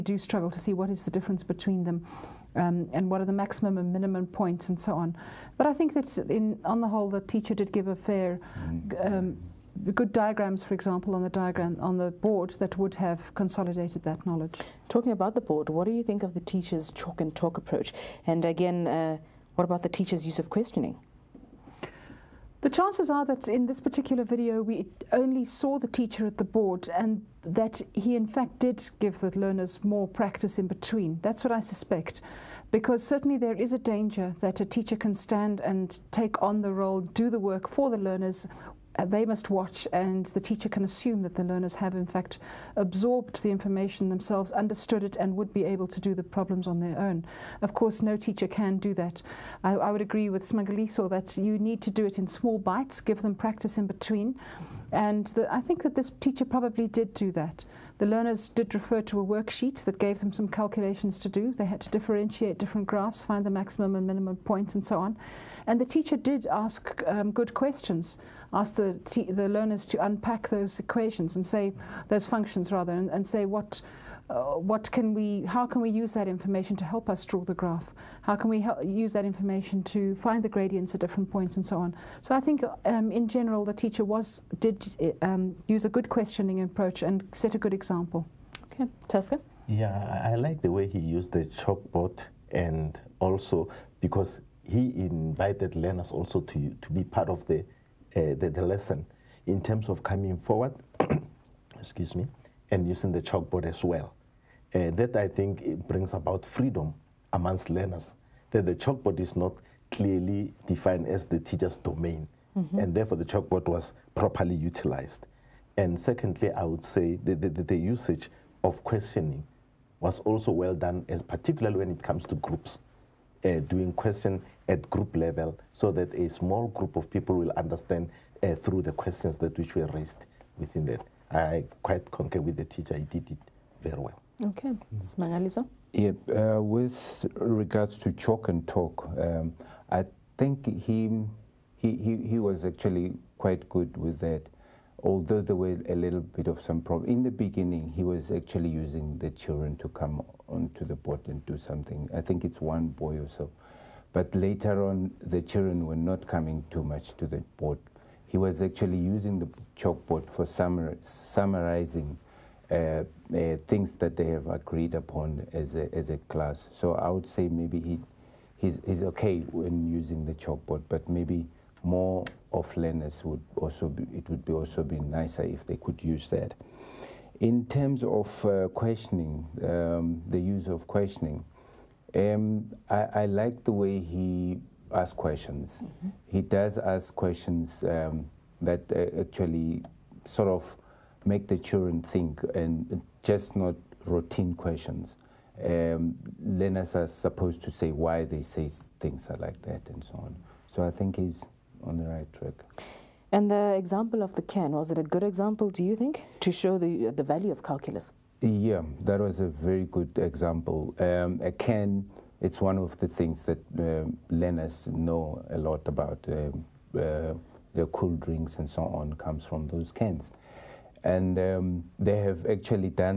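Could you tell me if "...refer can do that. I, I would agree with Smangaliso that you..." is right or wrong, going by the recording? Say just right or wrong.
wrong.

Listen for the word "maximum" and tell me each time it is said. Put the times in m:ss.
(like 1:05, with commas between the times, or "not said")
0:03, 1:03.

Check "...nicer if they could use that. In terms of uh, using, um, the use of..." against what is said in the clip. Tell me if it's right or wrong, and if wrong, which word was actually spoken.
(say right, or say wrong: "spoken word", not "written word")
wrong: "questioning", not "using".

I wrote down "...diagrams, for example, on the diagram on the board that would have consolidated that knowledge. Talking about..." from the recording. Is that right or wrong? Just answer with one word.
right.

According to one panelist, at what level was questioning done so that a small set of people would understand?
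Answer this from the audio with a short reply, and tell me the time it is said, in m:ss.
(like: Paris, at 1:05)
group level, at 2:04.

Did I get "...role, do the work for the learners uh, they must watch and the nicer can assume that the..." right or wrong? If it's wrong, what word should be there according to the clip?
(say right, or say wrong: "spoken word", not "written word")
wrong: "teacher", not "nicer".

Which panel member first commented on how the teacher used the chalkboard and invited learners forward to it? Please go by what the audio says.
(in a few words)
Tesca.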